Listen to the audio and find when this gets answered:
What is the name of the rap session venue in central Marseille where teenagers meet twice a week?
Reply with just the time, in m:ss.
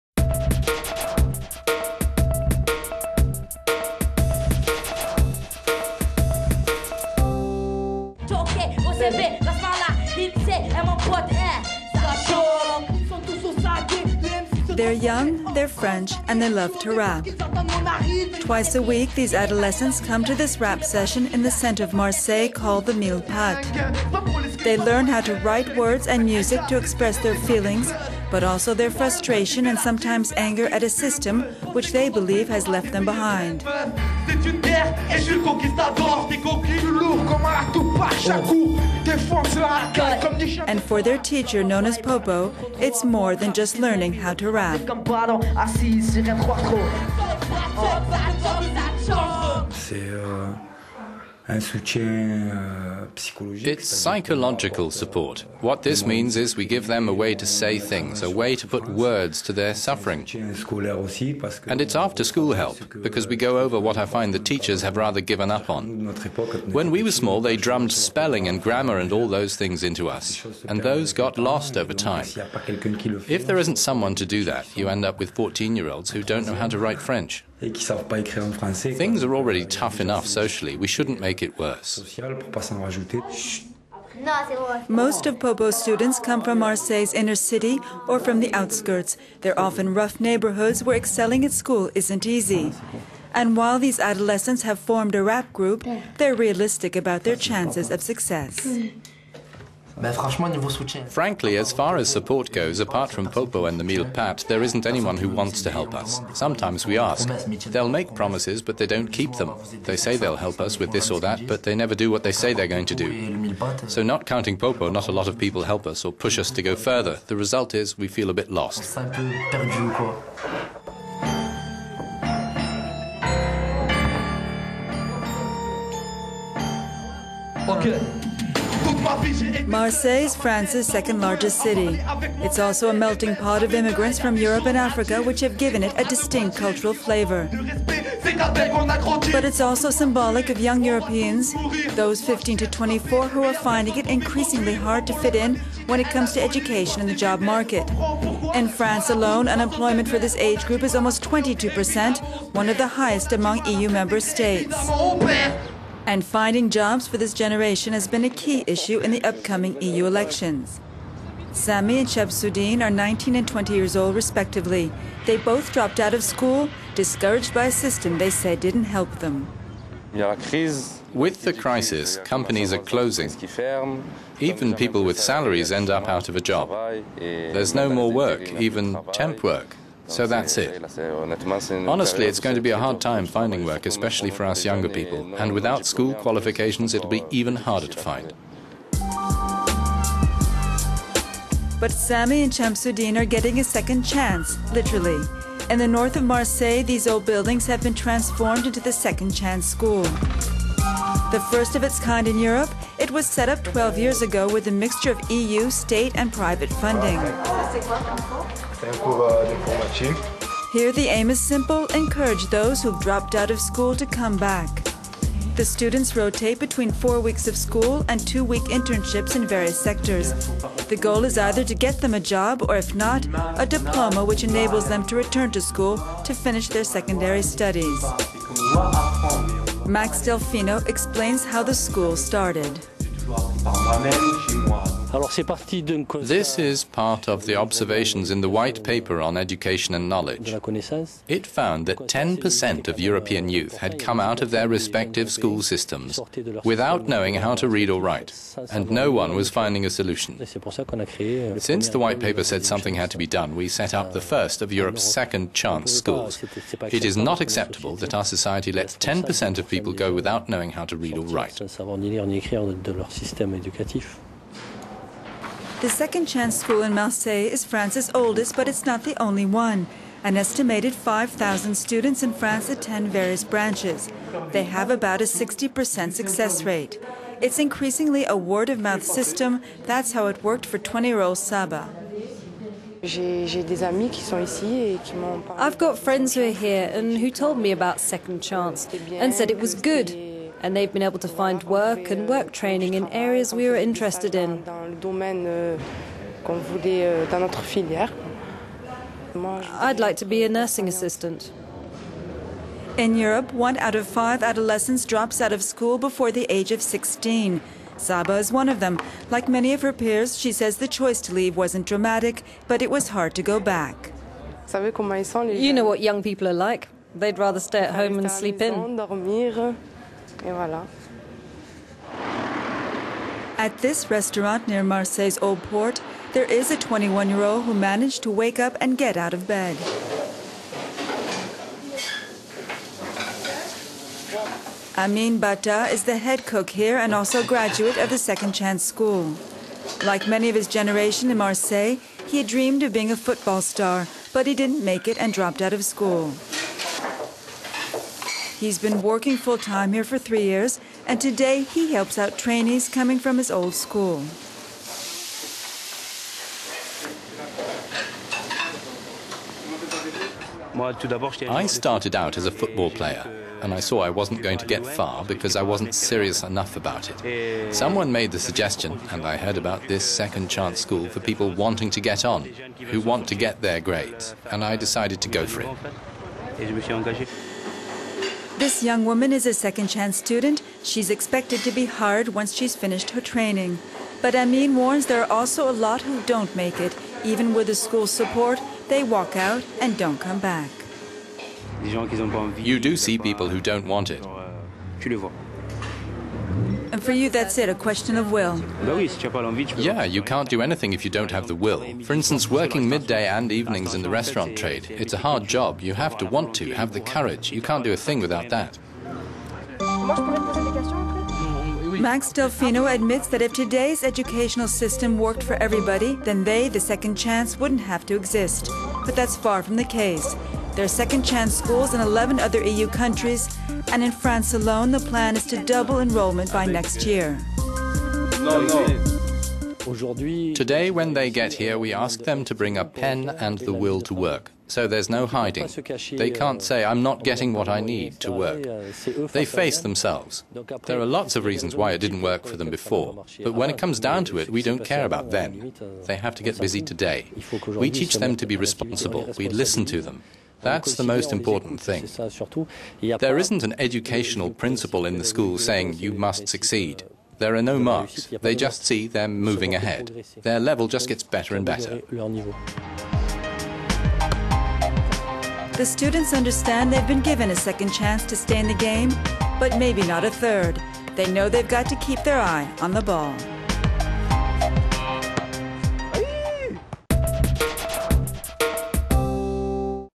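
1:43.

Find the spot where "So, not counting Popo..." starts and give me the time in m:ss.
1:53.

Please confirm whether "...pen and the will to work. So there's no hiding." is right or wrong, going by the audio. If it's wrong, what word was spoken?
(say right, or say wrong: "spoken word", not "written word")
right.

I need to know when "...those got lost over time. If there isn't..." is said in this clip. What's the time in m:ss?
1:10.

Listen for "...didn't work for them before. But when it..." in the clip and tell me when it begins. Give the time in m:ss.
7:21.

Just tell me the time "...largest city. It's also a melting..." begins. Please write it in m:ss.
2:11.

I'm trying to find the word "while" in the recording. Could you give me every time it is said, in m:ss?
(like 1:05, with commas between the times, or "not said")
1:33.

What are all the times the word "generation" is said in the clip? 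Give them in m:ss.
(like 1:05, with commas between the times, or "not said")
2:37, 5:40.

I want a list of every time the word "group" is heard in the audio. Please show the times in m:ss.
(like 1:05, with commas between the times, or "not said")
1:35, 2:30.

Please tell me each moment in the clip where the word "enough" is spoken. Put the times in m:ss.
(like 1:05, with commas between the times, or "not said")
1:20, 6:06.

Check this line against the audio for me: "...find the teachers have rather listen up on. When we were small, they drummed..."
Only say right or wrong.
wrong.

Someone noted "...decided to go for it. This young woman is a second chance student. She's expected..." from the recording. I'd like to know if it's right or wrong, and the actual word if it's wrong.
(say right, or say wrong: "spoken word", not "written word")
right.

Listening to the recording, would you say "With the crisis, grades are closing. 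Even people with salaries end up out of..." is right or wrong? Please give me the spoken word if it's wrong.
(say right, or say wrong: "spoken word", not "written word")
wrong: "companies", not "grades".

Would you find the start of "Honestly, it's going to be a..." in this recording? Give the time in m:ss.
3:00.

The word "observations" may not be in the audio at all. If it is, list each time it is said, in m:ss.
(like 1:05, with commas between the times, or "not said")
3:57.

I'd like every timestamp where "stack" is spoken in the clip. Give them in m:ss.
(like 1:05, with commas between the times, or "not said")
not said.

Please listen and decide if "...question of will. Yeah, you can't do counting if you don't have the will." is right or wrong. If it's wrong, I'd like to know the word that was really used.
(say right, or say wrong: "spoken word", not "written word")
wrong: "anything", not "counting".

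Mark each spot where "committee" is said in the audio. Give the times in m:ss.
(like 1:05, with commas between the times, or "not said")
not said.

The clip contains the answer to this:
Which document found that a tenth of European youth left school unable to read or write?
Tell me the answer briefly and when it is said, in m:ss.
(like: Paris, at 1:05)
white paper on education and knowledge, at 3:58.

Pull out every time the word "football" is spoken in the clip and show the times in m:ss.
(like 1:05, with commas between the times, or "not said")
5:43, 6:02.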